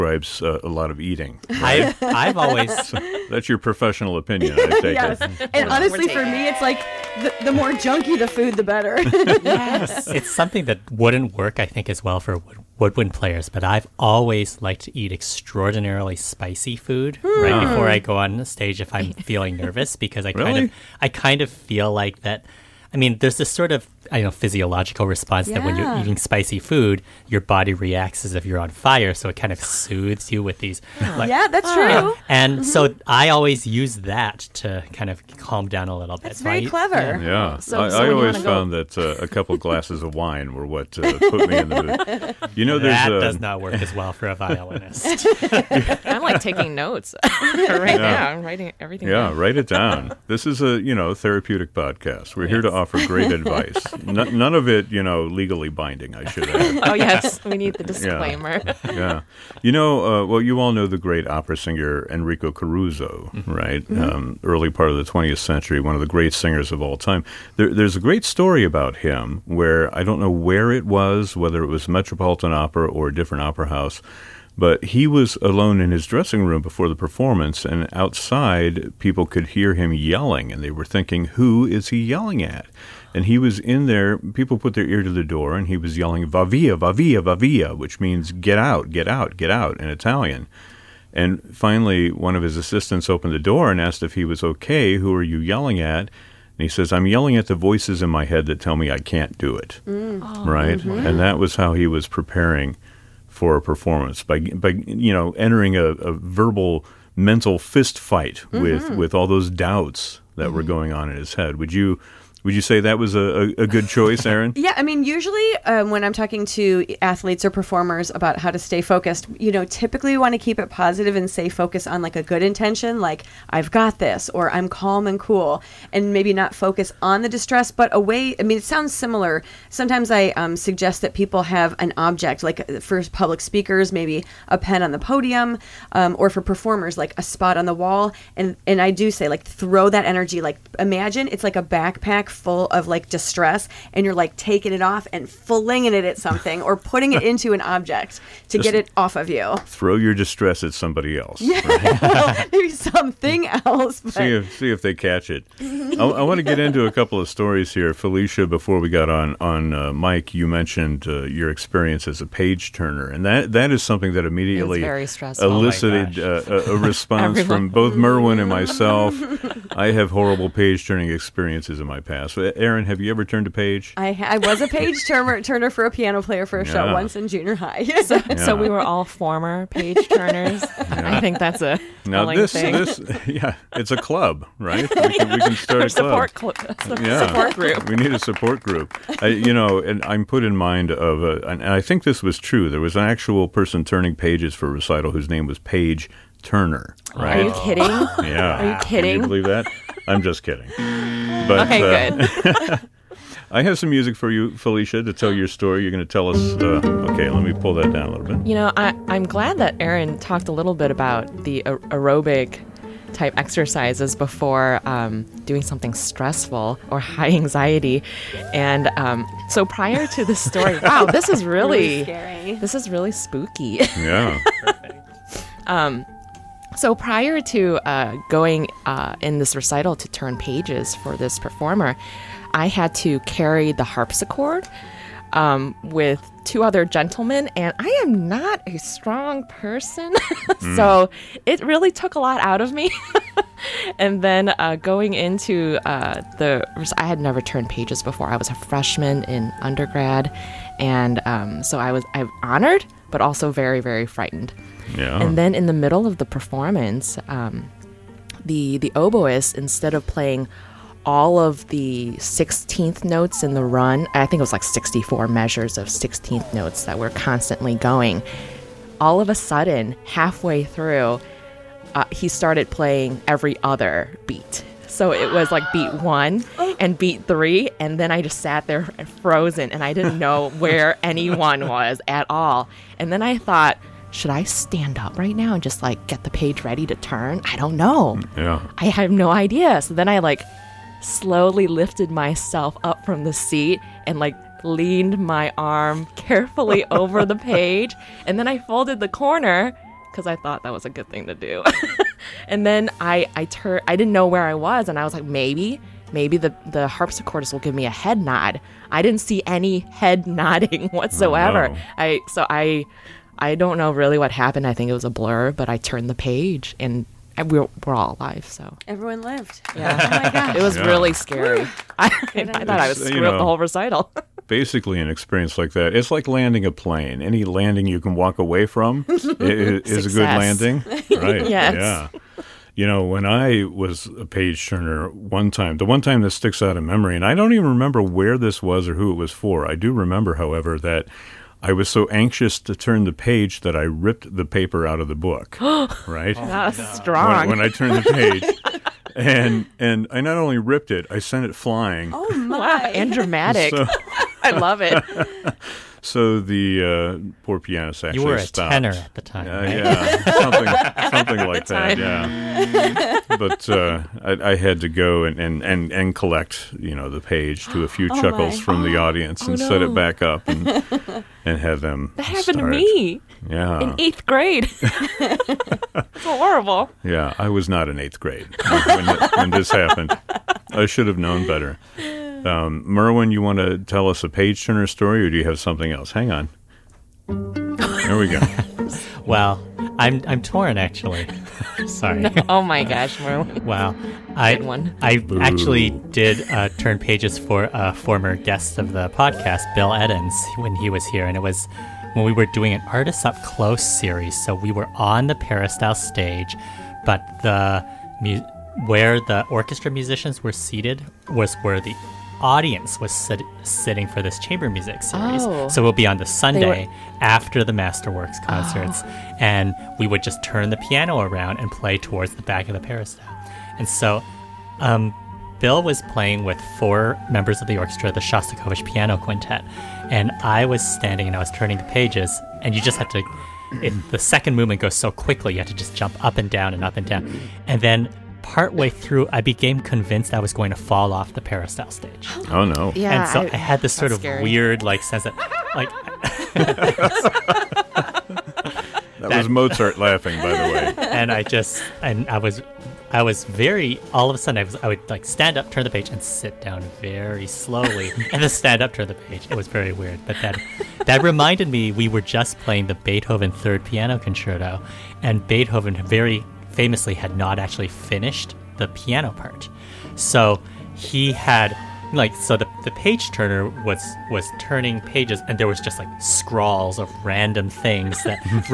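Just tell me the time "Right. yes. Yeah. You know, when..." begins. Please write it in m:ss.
5:31.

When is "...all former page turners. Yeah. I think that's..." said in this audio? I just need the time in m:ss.
2:58.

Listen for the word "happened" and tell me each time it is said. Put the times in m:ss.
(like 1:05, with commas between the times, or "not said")
5:14, 6:12, 6:19.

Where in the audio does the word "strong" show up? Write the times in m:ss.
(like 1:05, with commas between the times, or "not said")
3:58, 5:46.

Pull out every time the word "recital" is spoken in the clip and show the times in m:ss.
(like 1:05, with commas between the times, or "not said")
3:14, 3:49, 5:23.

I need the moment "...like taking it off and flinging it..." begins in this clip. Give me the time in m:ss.
2:24.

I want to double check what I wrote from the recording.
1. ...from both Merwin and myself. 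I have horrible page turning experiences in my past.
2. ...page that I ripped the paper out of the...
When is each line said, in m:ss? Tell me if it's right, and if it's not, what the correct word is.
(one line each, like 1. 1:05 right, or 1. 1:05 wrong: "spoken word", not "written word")
1. 2:47 right
2. 5:43 right.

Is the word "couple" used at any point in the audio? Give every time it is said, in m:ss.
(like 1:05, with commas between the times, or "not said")
0:39, 2:36.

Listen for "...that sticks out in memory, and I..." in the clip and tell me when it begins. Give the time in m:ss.
5:36.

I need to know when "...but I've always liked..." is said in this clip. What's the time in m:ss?
0:13.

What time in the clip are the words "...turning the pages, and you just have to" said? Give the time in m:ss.
7:11.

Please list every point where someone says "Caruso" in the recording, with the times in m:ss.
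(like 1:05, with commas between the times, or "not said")
1:02.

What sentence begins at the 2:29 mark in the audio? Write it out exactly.
Throw your distress at somebody else.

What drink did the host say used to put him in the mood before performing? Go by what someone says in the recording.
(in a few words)
wine.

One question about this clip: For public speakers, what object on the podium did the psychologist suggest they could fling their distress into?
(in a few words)
a pen.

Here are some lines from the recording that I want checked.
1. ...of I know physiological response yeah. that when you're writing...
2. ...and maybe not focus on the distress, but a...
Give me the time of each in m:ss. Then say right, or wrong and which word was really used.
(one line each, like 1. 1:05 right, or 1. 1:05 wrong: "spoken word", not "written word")
1. 0:23 wrong: "eating", not "writing"
2. 2:05 right.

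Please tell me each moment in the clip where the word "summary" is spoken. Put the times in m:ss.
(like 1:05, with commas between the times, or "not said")
not said.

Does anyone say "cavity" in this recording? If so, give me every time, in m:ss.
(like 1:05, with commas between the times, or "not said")
not said.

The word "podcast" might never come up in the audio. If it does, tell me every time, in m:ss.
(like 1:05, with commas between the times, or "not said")
0:51, 6:39.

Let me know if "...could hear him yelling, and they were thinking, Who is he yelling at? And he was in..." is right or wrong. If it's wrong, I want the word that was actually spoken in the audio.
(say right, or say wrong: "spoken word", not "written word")
right.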